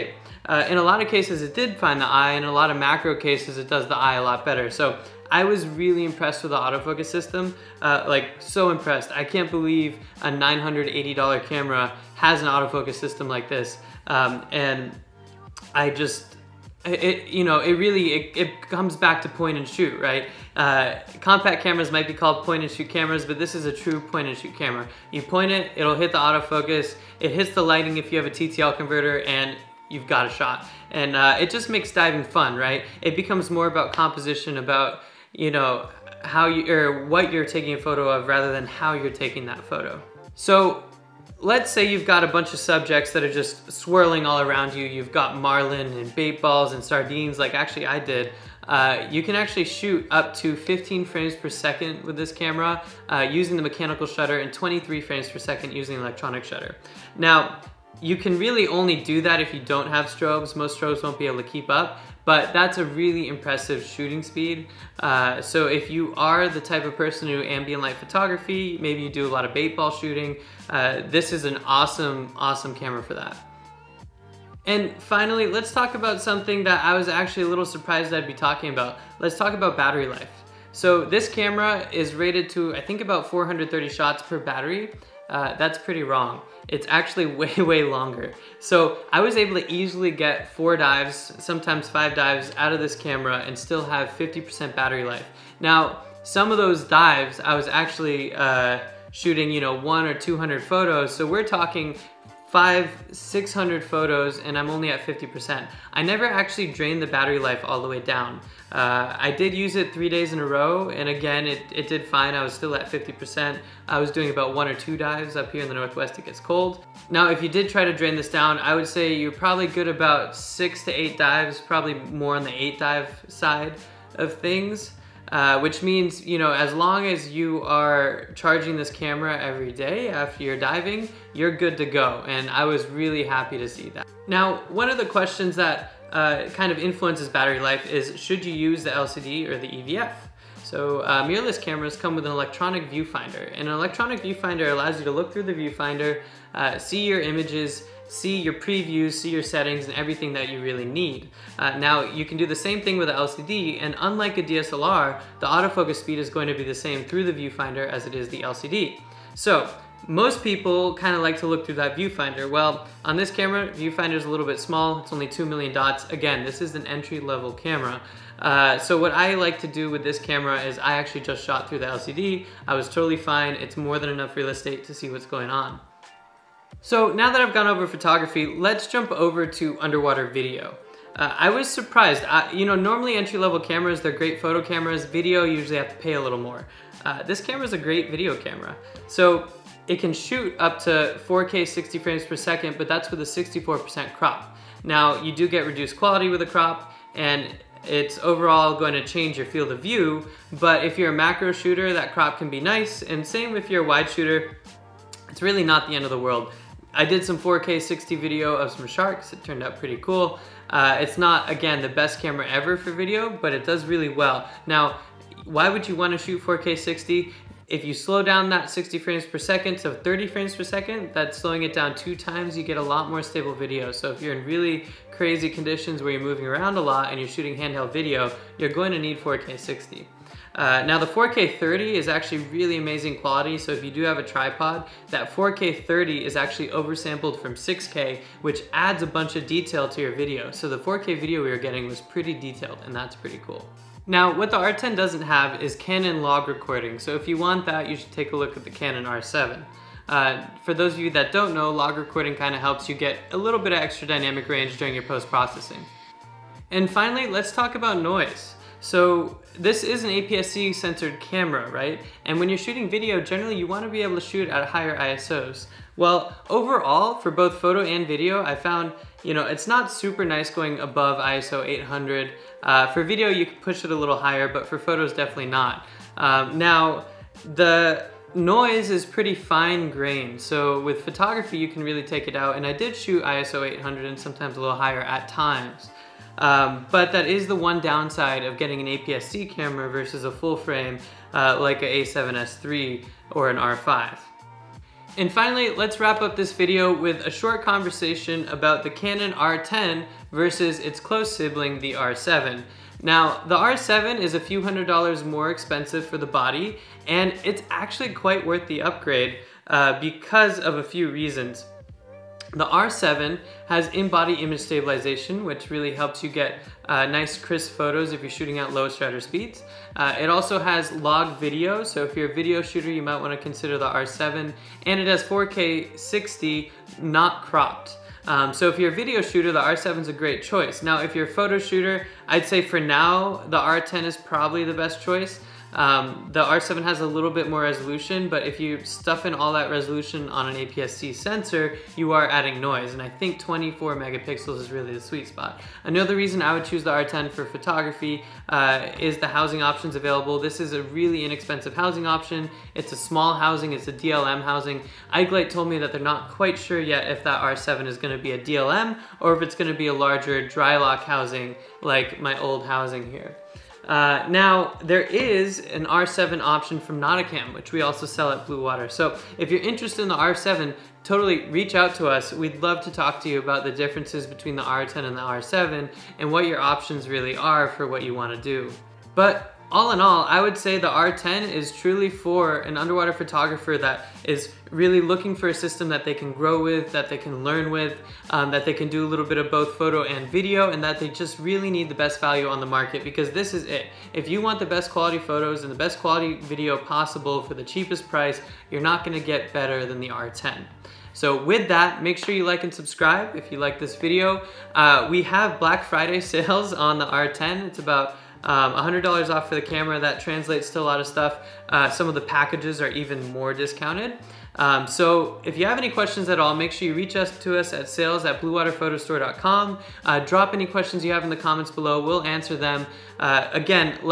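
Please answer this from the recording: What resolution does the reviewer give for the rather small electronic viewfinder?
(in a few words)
2 million dots.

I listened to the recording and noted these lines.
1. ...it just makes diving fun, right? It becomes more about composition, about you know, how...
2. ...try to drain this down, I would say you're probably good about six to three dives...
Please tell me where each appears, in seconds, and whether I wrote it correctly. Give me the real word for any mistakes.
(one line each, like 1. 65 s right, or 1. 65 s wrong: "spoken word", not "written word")
1. 31 s right
2. 117 s wrong: "eight", not "three".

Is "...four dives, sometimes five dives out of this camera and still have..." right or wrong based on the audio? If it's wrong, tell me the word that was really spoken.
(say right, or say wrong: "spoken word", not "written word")
right.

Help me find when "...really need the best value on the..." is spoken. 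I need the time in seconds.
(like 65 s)
391 s.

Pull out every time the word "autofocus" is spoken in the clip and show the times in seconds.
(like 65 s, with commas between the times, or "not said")
6 s, 12 s, 26 s, 155 s.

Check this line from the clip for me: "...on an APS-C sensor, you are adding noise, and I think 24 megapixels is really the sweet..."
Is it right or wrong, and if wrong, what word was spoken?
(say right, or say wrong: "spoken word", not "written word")
right.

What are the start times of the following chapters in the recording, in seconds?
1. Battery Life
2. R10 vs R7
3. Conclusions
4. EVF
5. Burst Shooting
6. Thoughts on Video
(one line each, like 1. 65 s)
1. 80 s
2. 298 s
3. 379 s
4. 135 s
5. 39 s
6. 175 s.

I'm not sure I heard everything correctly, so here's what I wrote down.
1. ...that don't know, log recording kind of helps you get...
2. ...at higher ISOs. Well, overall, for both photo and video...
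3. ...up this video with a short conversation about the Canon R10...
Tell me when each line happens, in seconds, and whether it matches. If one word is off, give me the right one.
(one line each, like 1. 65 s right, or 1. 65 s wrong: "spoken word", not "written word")
1. 251 s right
2. 264 s right
3. 296 s right.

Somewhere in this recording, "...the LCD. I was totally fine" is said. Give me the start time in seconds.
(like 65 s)
171 s.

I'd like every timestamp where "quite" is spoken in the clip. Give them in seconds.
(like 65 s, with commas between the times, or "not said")
308 s, 356 s.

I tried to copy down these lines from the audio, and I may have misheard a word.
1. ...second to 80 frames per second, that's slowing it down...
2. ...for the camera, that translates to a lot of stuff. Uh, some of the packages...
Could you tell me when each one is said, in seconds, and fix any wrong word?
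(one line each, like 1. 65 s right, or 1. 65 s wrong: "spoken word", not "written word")
1. 219 s wrong: "30", not "80"
2. 409 s right.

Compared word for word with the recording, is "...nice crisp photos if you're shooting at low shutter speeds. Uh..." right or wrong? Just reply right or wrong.
right.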